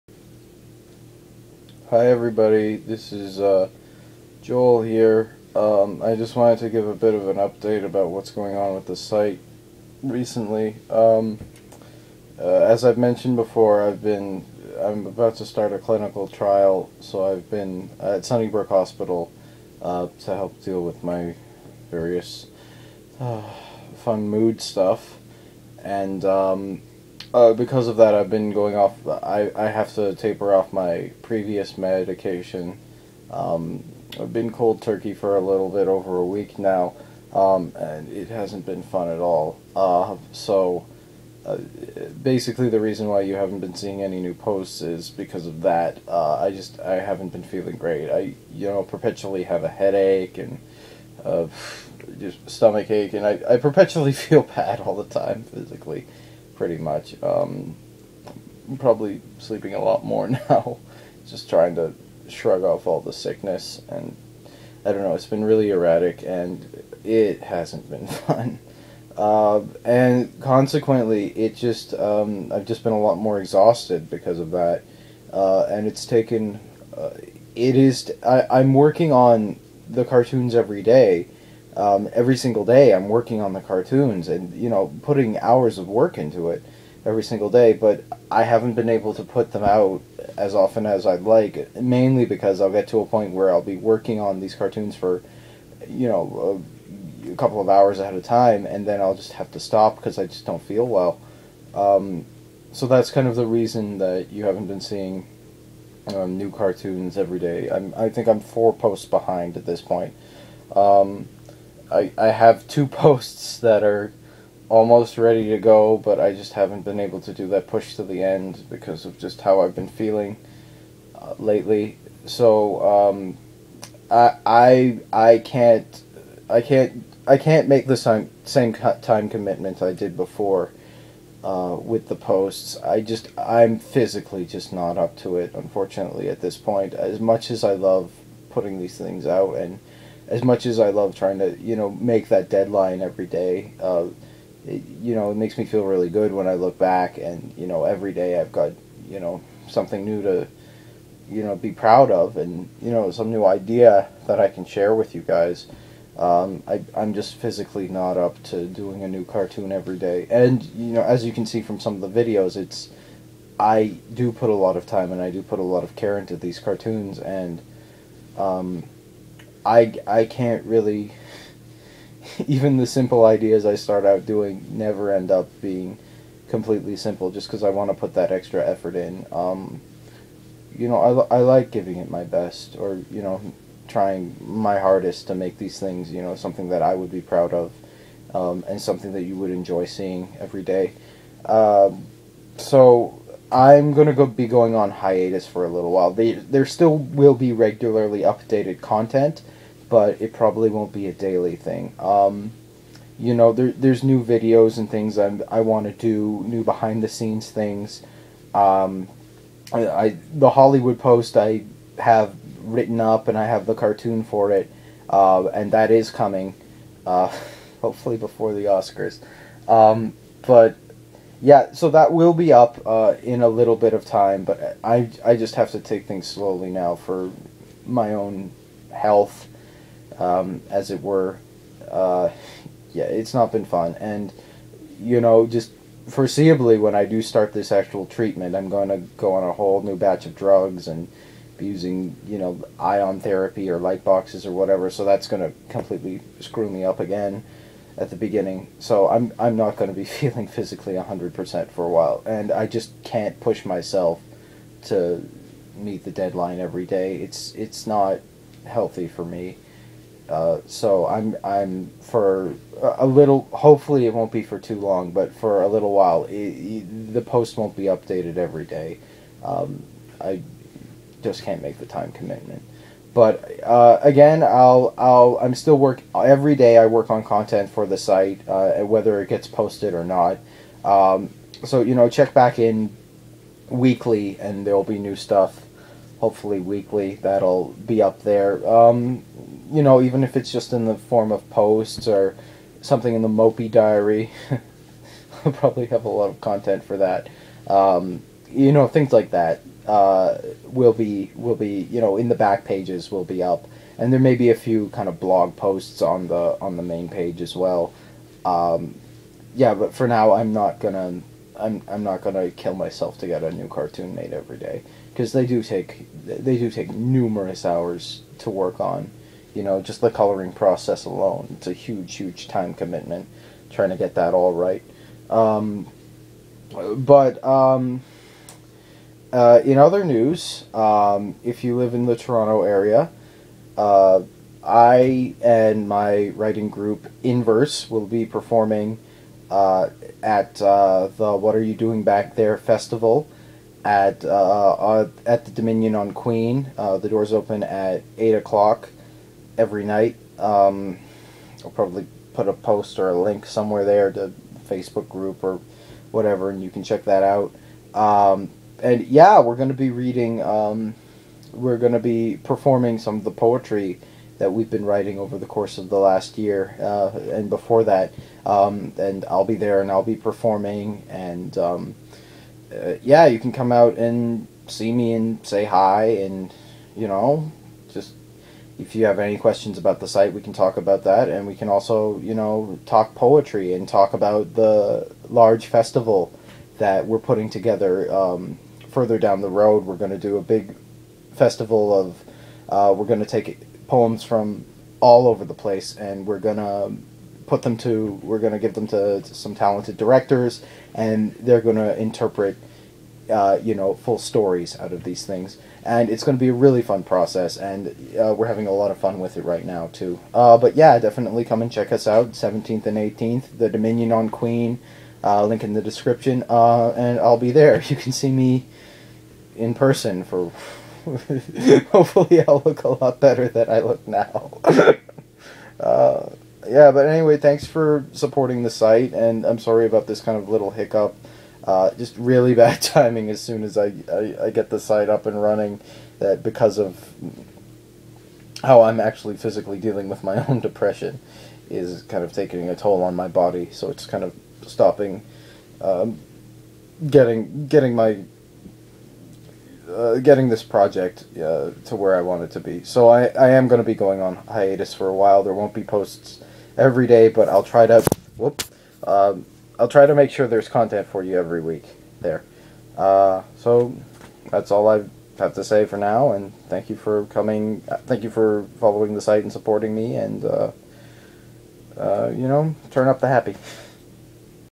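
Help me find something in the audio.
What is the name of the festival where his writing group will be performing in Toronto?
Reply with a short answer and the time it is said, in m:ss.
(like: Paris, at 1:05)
What Are You Doing Back There, at 5:41.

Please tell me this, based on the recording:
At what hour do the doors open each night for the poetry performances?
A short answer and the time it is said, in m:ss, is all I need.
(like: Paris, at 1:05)
8 o'clock, at 5:48.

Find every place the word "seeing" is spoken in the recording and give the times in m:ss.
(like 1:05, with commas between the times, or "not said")
0:43, 1:44, 3:09.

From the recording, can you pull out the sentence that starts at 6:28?
Um, further down the road, we're going to do a big festival of.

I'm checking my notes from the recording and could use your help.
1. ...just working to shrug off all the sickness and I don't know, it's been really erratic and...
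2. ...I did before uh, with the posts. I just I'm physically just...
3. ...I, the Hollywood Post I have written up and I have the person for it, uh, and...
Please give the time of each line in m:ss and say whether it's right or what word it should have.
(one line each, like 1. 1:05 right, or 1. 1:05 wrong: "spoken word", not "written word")
1. 1:01 wrong: "trying", not "working"
2. 2:09 right
3. 3:29 wrong: "cartoon", not "person".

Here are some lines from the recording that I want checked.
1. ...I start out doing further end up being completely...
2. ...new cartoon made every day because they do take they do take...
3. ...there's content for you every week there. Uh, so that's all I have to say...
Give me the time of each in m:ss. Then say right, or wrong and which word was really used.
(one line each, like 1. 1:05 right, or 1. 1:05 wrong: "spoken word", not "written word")
1. 2:53 wrong: "never", not "further"
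2. 5:13 right
3. 7:40 right.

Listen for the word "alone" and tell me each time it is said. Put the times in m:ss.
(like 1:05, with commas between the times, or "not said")
5:21.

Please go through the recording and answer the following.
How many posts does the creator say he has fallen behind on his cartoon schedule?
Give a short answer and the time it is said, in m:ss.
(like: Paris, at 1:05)
4, at 1:48.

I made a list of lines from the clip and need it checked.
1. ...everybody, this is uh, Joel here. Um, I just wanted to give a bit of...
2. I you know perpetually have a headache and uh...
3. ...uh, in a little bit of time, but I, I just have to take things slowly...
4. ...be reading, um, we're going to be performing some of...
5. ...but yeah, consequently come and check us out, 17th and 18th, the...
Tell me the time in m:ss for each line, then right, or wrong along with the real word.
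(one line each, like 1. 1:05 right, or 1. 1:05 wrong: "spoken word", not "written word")
1. 0:02 right
2. 0:48 right
3. 3:42 right
4. 5:59 right
5. 6:50 wrong: "definitely", not "consequently".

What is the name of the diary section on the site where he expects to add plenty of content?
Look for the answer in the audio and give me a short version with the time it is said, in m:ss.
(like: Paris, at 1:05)
Mopey diary, at 4:53.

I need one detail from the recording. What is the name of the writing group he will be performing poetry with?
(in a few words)
Inverse.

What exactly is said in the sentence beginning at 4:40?
Um, so you know, check back in weekly, and there will be new stuff.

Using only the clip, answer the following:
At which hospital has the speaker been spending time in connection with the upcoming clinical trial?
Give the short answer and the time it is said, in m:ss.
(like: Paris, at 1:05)
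Sunnybrook Hospital, at 0:18.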